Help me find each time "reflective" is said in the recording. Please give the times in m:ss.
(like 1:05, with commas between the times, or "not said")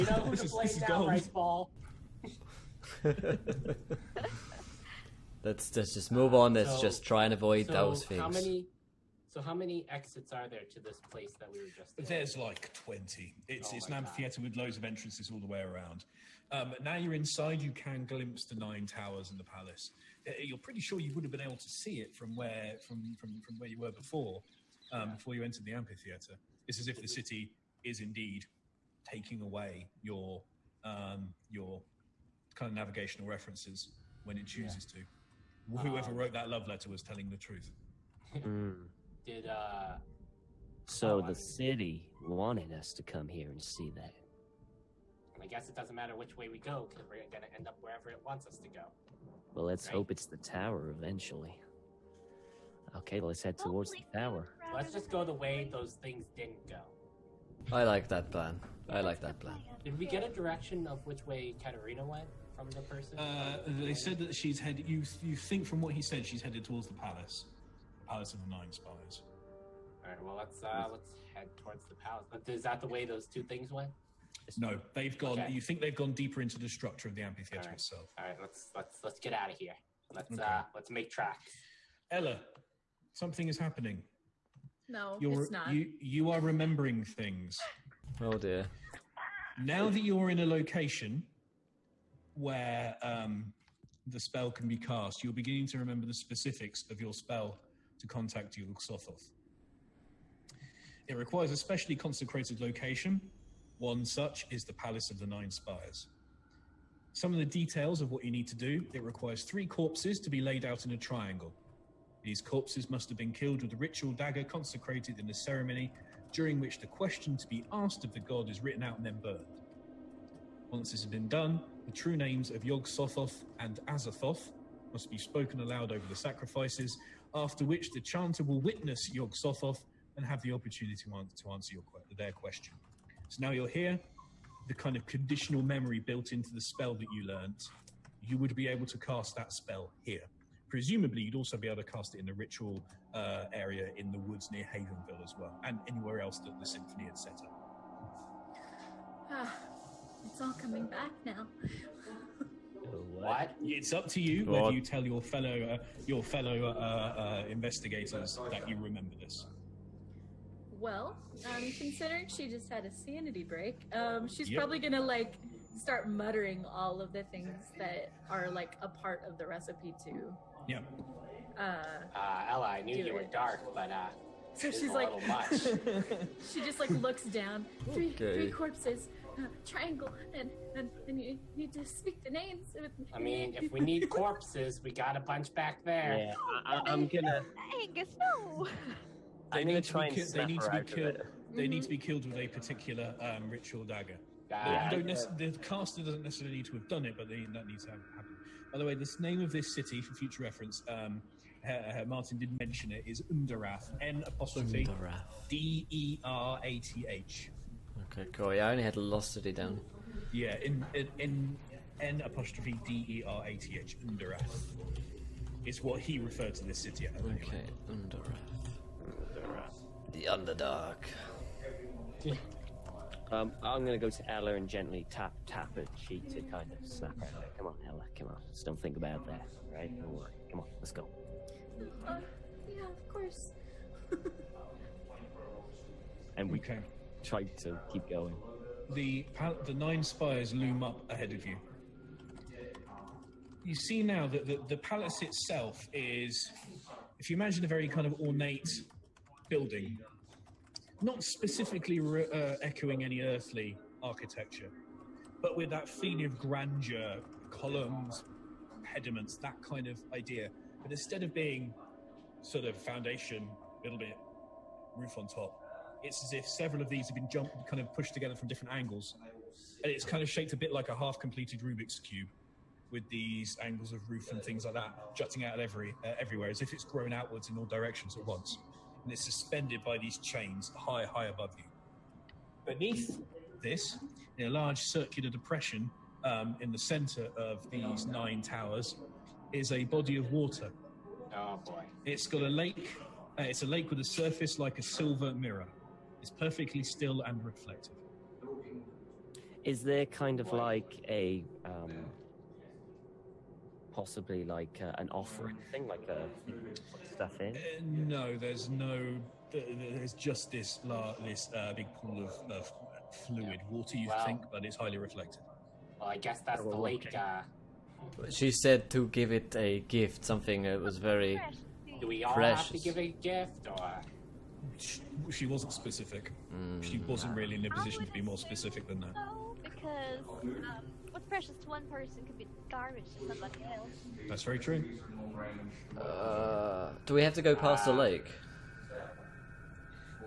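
4:57, 5:14.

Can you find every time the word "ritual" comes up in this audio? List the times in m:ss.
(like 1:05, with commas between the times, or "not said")
1:53, 2:22, 3:13.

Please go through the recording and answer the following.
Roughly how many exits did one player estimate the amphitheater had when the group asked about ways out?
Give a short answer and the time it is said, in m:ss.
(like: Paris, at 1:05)
20, at 0:12.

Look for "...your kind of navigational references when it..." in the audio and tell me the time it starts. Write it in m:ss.
0:31.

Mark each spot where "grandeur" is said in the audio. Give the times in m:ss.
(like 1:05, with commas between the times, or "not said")
4:16.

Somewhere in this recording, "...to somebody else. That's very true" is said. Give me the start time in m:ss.
5:33.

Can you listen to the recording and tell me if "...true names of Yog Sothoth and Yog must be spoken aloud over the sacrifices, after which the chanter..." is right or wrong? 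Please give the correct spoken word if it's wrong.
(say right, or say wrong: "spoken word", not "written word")
wrong: "Azathoth", not "Yog".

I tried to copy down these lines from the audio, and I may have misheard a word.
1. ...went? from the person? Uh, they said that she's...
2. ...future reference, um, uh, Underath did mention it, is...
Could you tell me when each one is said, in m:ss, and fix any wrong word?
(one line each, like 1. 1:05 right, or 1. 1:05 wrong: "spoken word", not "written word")
1. 1:02 right
2. 3:20 wrong: "Martin", not "Underath".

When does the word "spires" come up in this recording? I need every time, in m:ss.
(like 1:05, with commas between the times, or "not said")
1:45, 4:00.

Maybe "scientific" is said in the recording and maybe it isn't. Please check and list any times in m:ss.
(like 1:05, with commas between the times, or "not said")
not said.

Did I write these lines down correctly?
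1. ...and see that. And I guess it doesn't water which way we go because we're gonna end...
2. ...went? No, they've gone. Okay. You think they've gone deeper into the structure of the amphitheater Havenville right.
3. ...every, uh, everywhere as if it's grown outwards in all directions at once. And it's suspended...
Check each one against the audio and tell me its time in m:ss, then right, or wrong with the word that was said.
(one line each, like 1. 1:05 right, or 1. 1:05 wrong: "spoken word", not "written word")
1. 0:43 wrong: "matter", not "water"
2. 1:13 wrong: "All", not "Havenville"
3. 4:35 right.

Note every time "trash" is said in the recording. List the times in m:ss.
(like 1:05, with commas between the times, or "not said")
not said.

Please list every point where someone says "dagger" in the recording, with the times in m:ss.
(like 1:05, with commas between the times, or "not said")
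1:54, 3:13.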